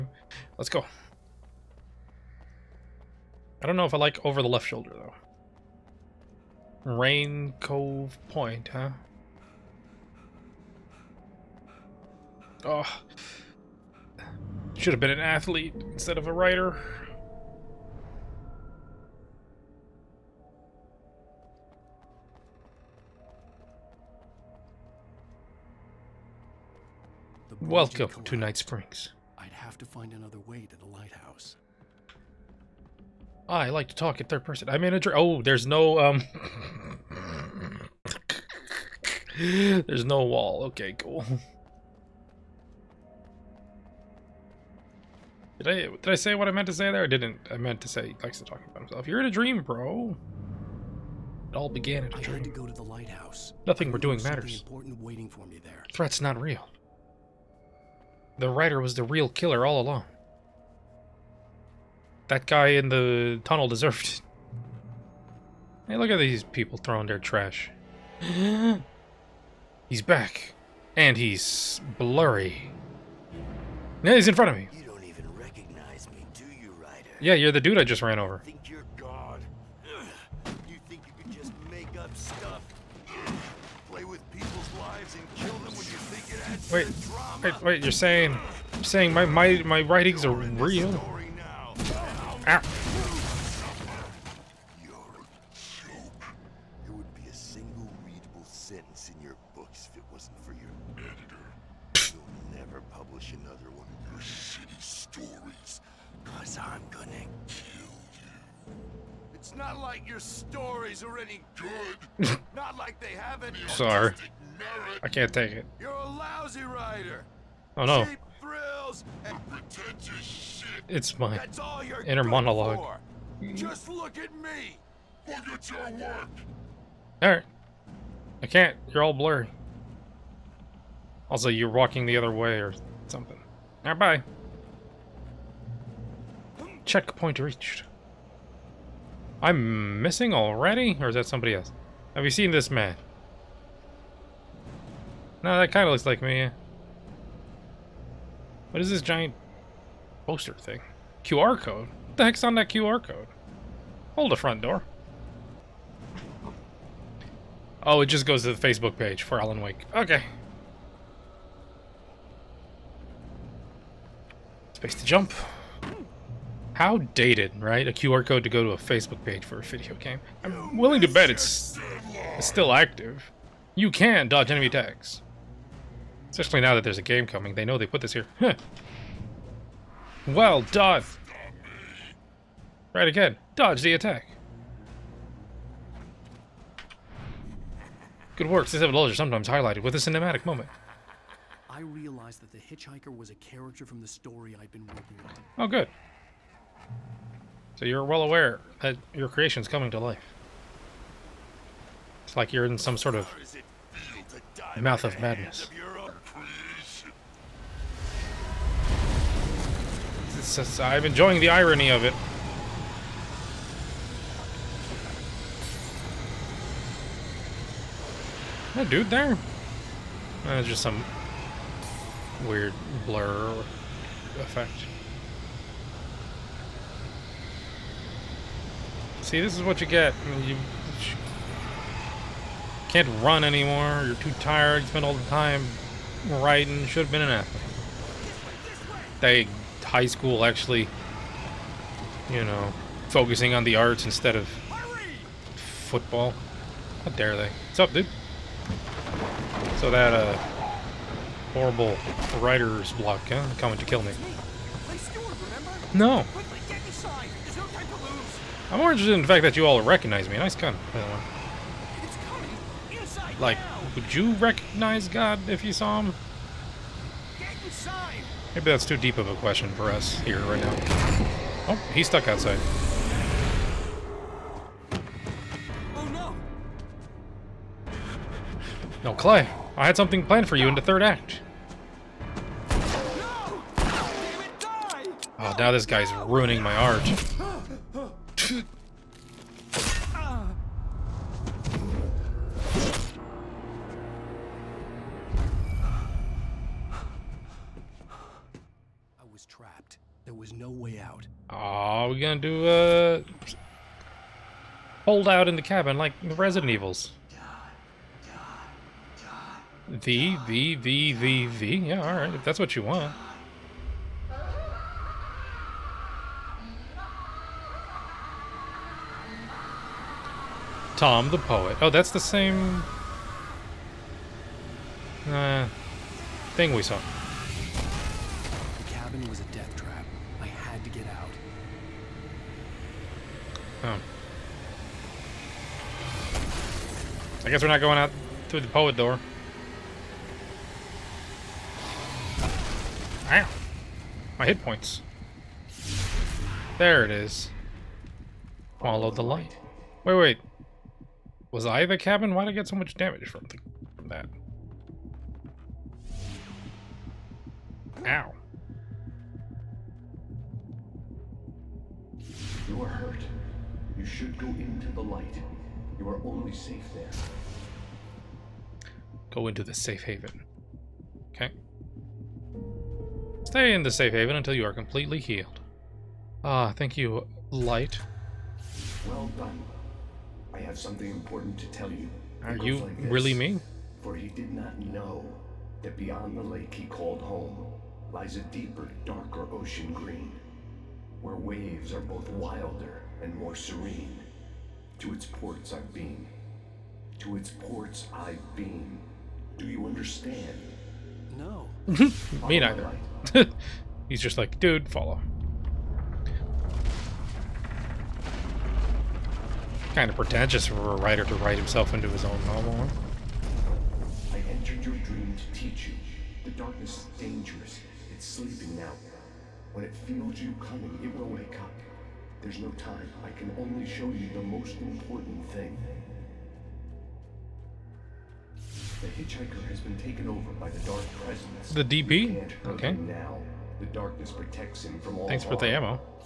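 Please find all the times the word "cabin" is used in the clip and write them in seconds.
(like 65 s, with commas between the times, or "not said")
305 s, 351 s.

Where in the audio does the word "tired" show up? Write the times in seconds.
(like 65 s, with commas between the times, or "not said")
234 s.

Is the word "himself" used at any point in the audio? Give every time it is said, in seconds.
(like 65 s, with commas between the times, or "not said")
48 s, 411 s.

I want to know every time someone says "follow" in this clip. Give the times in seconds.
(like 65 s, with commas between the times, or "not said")
348 s, 404 s.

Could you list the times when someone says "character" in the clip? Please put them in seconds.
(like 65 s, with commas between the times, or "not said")
193 s.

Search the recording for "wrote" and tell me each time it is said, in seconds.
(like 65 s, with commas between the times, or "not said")
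not said.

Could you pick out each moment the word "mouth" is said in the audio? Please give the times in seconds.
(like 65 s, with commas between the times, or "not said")
204 s.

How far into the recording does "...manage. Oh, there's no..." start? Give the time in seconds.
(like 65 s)
34 s.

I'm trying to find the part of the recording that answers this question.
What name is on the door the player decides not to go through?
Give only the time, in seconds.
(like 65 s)
320 s.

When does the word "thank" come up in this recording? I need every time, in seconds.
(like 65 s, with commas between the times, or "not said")
376 s, 435 s.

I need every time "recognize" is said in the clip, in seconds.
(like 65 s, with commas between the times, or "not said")
259 s, 264 s.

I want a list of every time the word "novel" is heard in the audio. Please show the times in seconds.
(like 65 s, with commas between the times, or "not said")
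412 s.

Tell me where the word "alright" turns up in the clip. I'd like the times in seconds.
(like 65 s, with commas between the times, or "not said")
127 s, 133 s, 312 s.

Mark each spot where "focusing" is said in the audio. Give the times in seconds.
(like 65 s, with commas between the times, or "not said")
243 s.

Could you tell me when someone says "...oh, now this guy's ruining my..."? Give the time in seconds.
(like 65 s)
284 s.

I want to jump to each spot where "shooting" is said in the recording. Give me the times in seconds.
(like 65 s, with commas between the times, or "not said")
not said.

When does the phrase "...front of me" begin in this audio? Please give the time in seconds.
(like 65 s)
74 s.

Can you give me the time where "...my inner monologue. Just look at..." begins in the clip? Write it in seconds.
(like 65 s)
121 s.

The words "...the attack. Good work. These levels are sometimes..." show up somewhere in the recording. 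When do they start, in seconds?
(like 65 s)
183 s.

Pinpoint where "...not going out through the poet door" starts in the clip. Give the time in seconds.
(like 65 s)
337 s.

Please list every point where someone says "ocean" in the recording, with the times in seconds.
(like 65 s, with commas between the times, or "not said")
389 s.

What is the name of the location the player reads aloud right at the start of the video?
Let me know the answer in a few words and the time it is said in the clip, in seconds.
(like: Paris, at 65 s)
Rain Cove Point, at 6 s.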